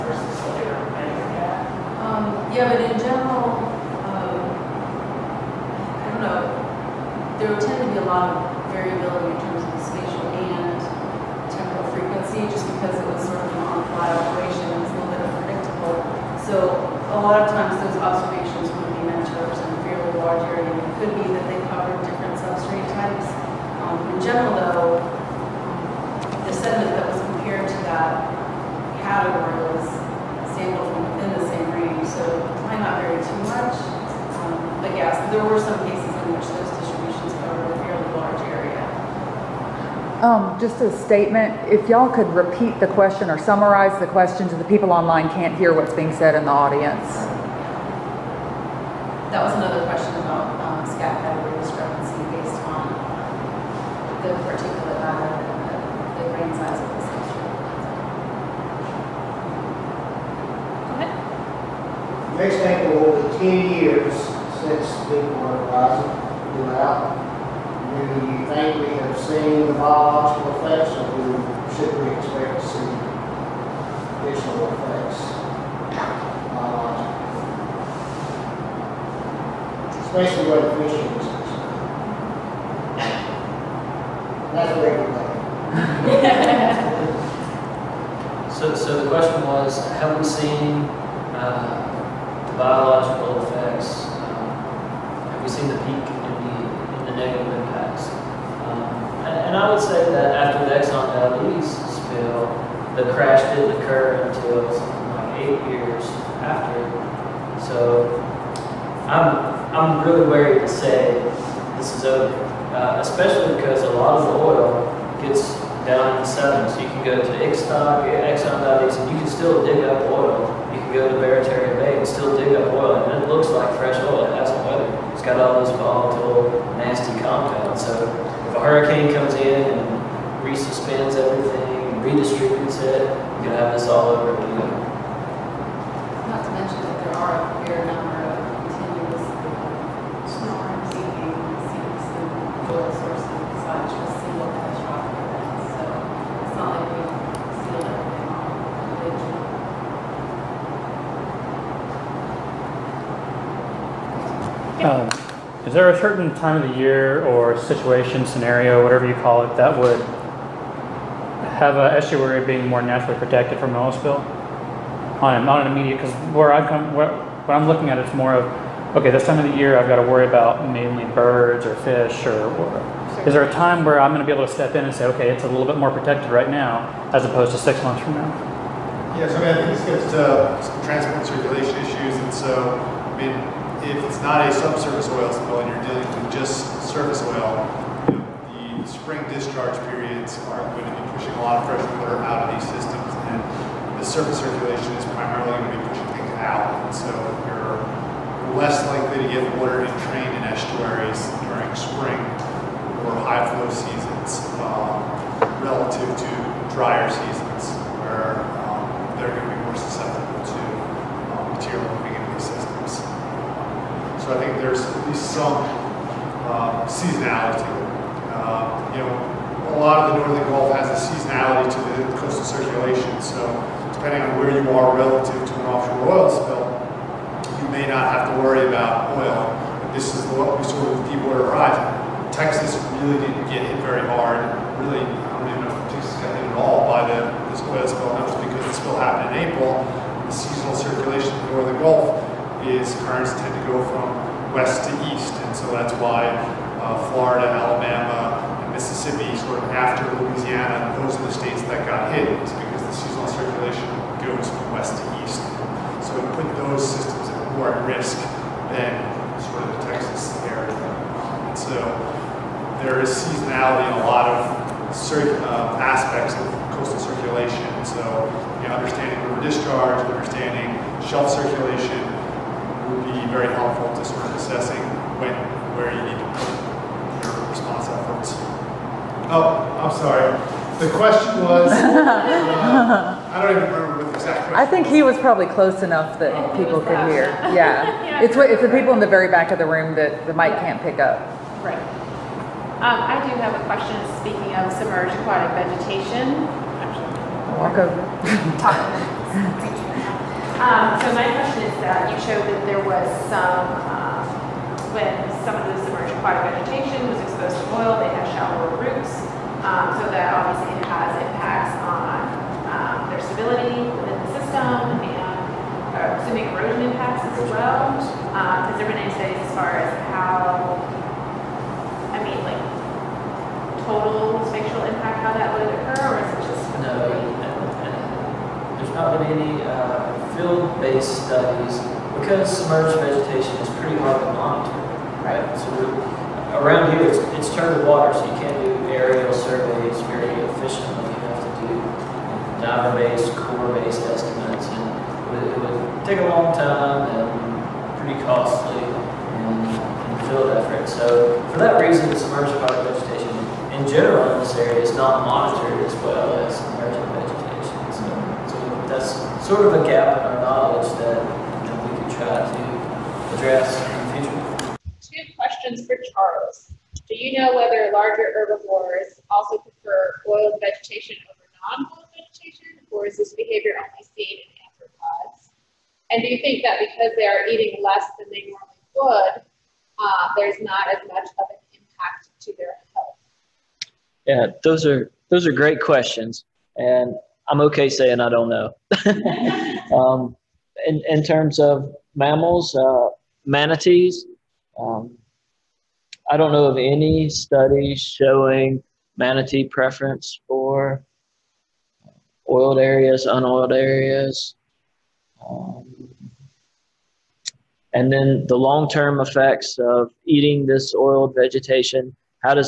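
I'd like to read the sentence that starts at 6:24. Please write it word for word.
Yeah, those are those are great questions, and I'm okay saying I don't know.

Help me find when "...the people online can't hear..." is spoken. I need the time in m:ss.
0:44.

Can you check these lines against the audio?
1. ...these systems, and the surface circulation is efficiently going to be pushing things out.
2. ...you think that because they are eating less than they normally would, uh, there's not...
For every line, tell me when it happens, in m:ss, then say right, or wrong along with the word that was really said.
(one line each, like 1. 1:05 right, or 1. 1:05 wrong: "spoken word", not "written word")
1. 3:12 wrong: "primarily", not "efficiently"
2. 6:16 right.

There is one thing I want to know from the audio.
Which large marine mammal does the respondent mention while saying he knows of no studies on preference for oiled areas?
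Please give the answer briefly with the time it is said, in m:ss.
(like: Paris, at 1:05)
Manatees, at 6:33.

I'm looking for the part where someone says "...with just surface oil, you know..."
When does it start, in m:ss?
3:06.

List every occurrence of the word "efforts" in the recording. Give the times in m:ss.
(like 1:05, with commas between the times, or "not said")
4:37, 5:50.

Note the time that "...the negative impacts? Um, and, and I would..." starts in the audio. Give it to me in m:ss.
1:37.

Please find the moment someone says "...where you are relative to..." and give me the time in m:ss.
3:44.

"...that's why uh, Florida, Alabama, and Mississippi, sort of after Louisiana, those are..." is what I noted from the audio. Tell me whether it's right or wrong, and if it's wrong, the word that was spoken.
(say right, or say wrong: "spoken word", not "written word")
right.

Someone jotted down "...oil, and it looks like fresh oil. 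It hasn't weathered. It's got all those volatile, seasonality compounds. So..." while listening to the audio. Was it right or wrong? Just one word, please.
wrong.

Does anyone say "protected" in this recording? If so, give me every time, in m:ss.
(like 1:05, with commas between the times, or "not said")
2:43, 2:55.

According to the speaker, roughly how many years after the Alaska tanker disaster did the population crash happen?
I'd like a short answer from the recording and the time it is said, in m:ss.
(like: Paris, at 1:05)
8 years, at 1:45.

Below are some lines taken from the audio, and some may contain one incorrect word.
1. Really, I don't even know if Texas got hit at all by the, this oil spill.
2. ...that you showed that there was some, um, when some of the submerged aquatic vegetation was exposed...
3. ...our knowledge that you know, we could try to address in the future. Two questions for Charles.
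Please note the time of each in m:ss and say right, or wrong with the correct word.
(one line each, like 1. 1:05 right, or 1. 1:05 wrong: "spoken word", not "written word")
1. 3:54 right
2. 5:01 right
3. 6:00 right.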